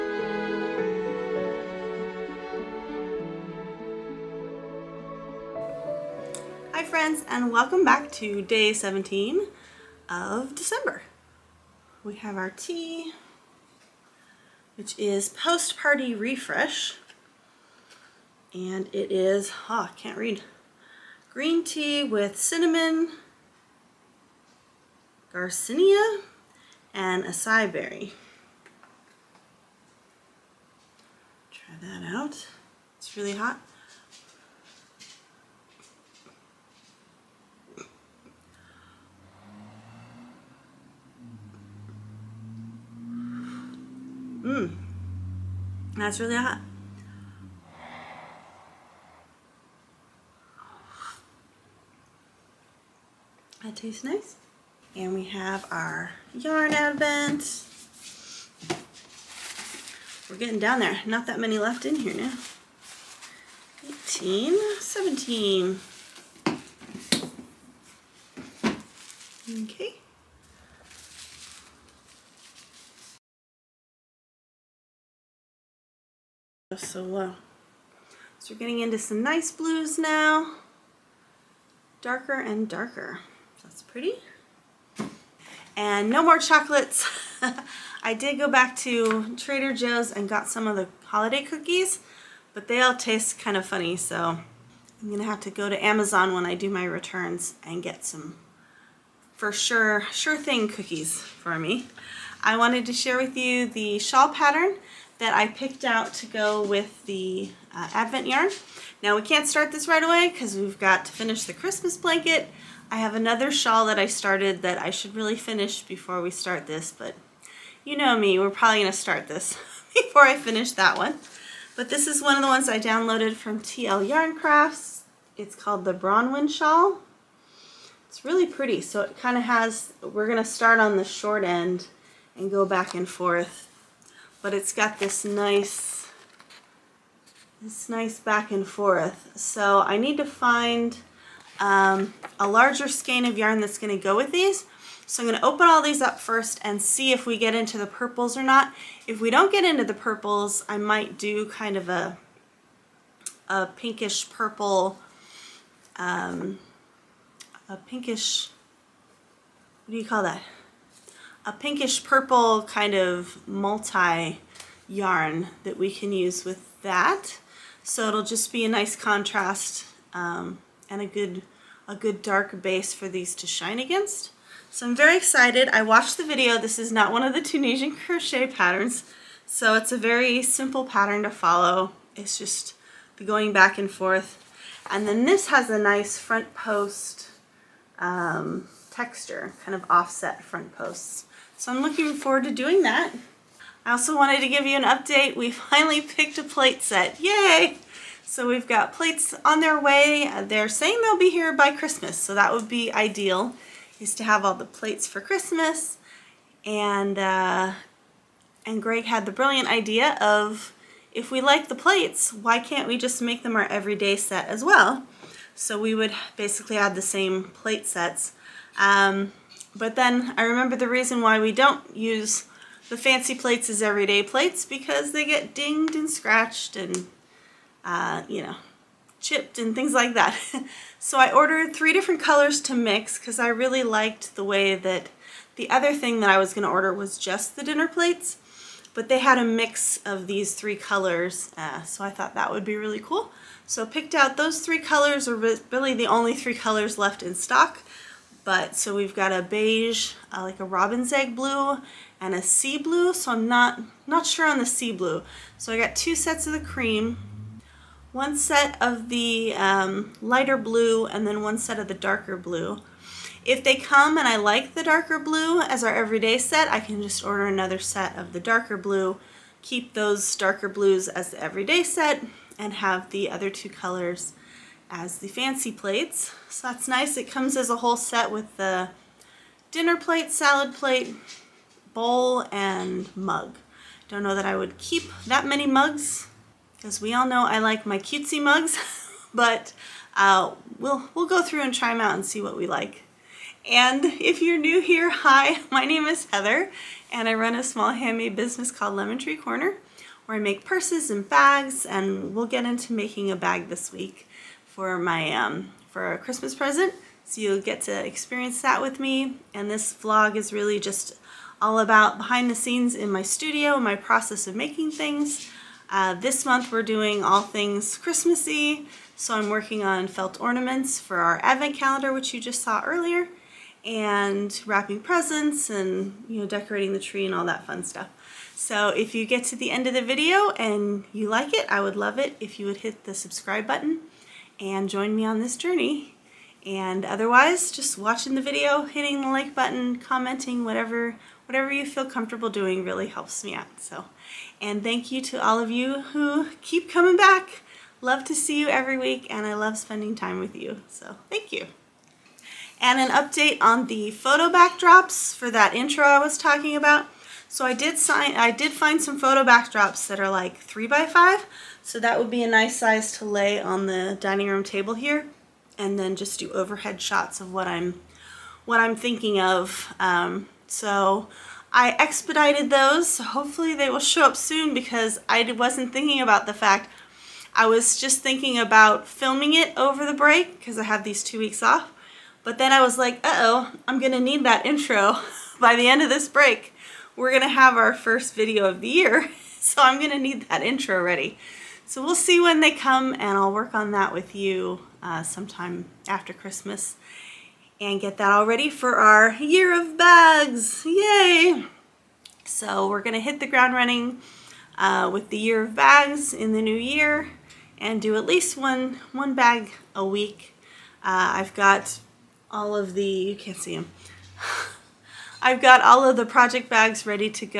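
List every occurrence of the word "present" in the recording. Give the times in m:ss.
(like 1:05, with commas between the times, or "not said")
5:06, 5:25.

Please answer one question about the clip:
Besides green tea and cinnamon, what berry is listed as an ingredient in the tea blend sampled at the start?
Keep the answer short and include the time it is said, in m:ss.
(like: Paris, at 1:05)
acai berry, at 0:27.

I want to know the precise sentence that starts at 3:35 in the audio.
So we would basically add the same plate sets.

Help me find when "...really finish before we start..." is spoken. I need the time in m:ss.
1:55.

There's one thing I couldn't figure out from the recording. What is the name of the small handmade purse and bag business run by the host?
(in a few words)
Lemon Tree Corner.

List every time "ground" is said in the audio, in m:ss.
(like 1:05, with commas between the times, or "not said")
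6:43.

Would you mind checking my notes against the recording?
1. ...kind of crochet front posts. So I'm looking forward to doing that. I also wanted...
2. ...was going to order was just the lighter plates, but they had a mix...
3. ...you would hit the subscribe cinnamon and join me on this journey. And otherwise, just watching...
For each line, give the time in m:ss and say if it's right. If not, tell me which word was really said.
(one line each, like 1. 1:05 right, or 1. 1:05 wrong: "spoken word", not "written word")
1. 3:09 wrong: "offset", not "crochet"
2. 3:56 wrong: "dinner", not "lighter"
3. 5:32 wrong: "button", not "cinnamon".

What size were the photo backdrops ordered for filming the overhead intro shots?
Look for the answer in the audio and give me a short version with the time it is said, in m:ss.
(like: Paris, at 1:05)
3 by 5, at 6:00.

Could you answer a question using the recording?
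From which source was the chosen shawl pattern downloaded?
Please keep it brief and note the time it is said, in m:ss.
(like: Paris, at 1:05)
TL Yarn Crafts, at 2:03.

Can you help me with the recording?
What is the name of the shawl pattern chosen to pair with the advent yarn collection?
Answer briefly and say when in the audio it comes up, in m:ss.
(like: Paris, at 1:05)
Bronwyn Shawl, at 2:05.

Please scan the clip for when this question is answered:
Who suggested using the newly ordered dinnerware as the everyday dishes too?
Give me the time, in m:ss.
3:28.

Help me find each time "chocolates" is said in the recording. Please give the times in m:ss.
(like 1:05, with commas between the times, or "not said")
1:26.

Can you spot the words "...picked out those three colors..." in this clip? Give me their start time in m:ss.
4:03.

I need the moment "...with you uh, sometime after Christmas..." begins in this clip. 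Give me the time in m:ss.
6:34.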